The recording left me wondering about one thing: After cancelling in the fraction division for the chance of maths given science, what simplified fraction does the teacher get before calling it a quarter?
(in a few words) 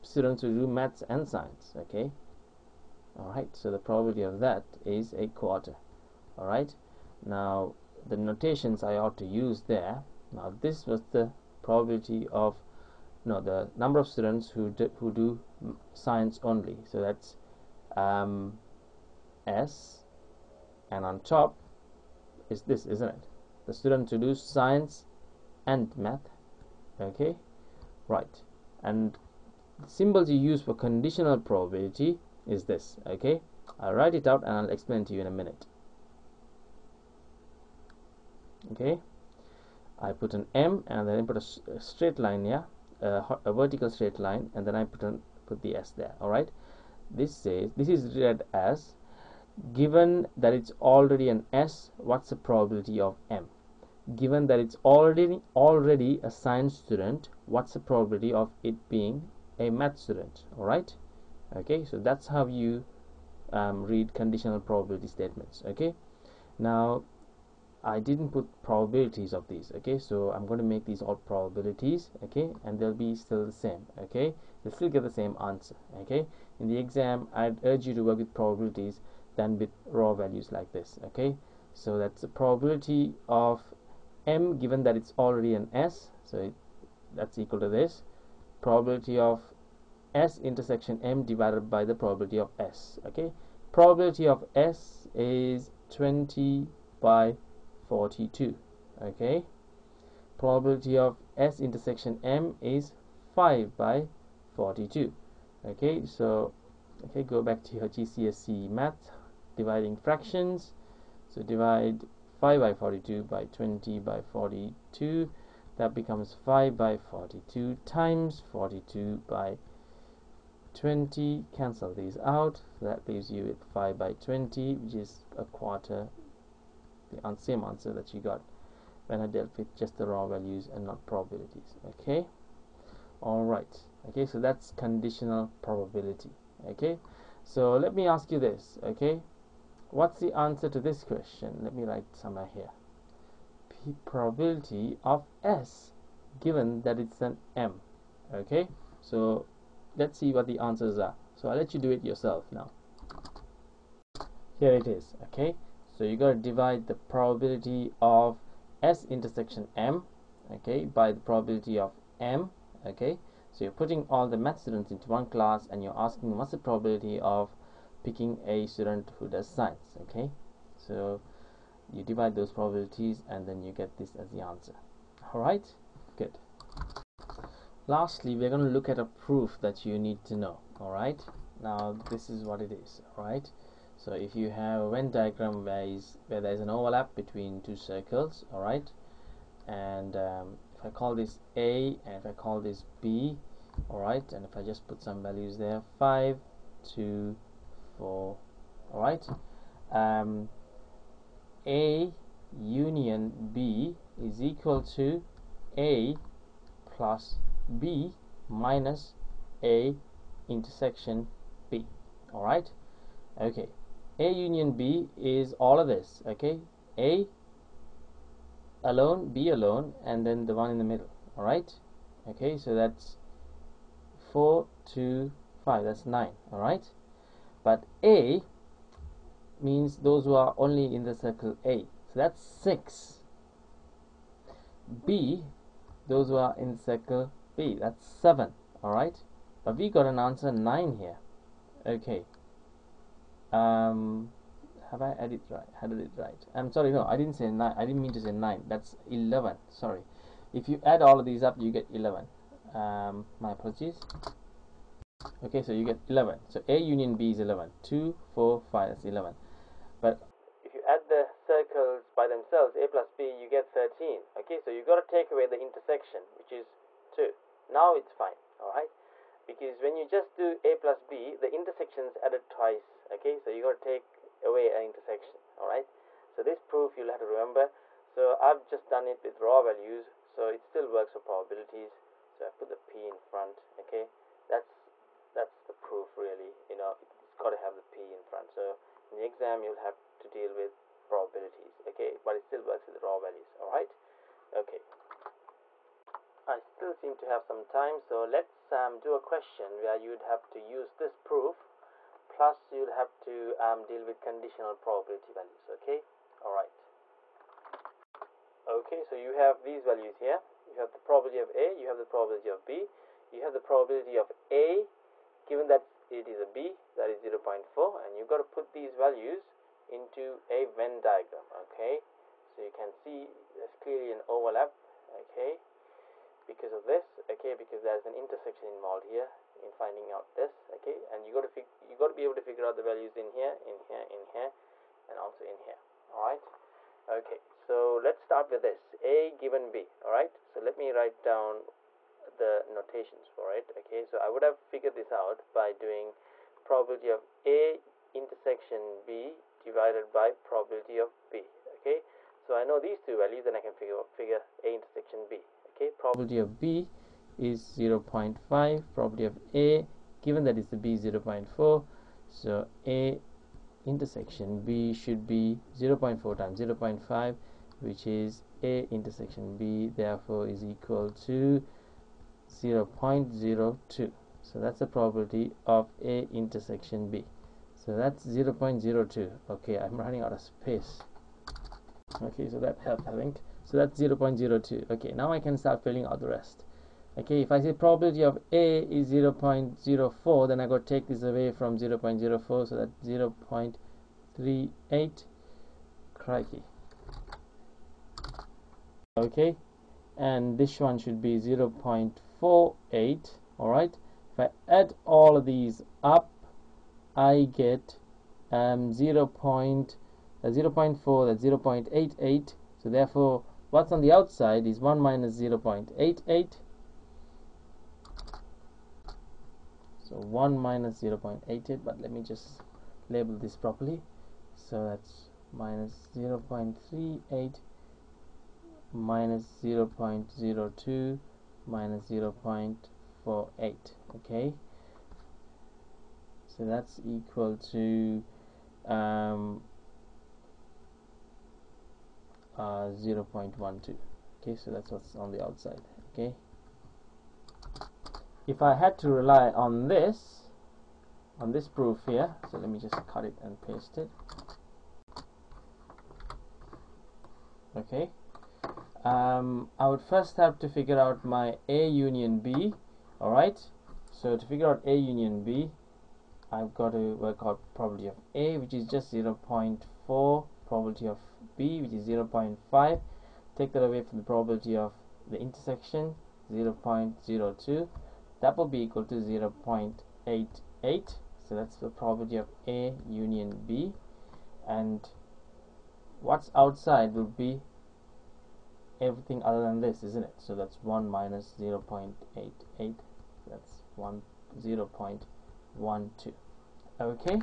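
5/20.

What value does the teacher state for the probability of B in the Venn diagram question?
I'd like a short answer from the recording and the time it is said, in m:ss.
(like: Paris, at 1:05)
0.5, at 5:55.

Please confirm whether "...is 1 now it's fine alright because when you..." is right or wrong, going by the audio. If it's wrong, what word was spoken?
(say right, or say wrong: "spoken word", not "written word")
wrong: "2", not "1".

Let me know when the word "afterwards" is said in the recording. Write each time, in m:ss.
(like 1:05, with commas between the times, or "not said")
not said.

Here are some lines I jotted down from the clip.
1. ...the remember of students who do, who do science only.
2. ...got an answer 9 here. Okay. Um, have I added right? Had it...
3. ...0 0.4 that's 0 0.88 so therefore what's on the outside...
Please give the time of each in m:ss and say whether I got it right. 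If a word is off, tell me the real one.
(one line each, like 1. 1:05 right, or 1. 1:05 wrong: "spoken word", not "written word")
1. 0:13 wrong: "number", not "remember"
2. 3:59 right
3. 6:50 right.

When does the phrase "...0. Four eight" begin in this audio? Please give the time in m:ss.
6:41.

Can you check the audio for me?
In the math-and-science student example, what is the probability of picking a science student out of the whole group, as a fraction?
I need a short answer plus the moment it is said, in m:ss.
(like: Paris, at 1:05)
20/42, at 1:33.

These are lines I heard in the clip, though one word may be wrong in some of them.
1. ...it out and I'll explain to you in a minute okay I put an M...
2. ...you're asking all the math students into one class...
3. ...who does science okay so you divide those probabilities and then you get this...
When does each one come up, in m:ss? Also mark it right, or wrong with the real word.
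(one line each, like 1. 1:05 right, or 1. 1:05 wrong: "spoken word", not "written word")
1. 0:34 right
2. 2:43 wrong: "putting", not "asking"
3. 2:49 right.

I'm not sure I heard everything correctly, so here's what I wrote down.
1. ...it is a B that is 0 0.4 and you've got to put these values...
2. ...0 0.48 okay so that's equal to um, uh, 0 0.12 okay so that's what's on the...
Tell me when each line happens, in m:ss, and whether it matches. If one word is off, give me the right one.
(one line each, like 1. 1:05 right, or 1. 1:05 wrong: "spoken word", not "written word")
1. 5:16 right
2. 7:12 right.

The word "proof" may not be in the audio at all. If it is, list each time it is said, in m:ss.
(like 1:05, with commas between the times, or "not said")
2:59, 4:36, 4:45, 5:01, 7:31.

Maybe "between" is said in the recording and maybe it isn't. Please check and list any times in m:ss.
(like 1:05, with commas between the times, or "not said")
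3:07.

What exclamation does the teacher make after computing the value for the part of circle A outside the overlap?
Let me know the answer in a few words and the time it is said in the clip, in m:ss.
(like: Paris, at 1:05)
Crikey, at 6:36.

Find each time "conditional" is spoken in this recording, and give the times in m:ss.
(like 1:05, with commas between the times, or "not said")
0:30, 1:04, 2:14, 5:04.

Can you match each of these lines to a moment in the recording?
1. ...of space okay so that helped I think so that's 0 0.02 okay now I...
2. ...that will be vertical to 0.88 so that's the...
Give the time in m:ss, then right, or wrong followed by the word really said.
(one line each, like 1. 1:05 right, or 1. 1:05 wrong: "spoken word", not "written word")
1. 6:20 right
2. 7:58 wrong: "equal", not "vertical".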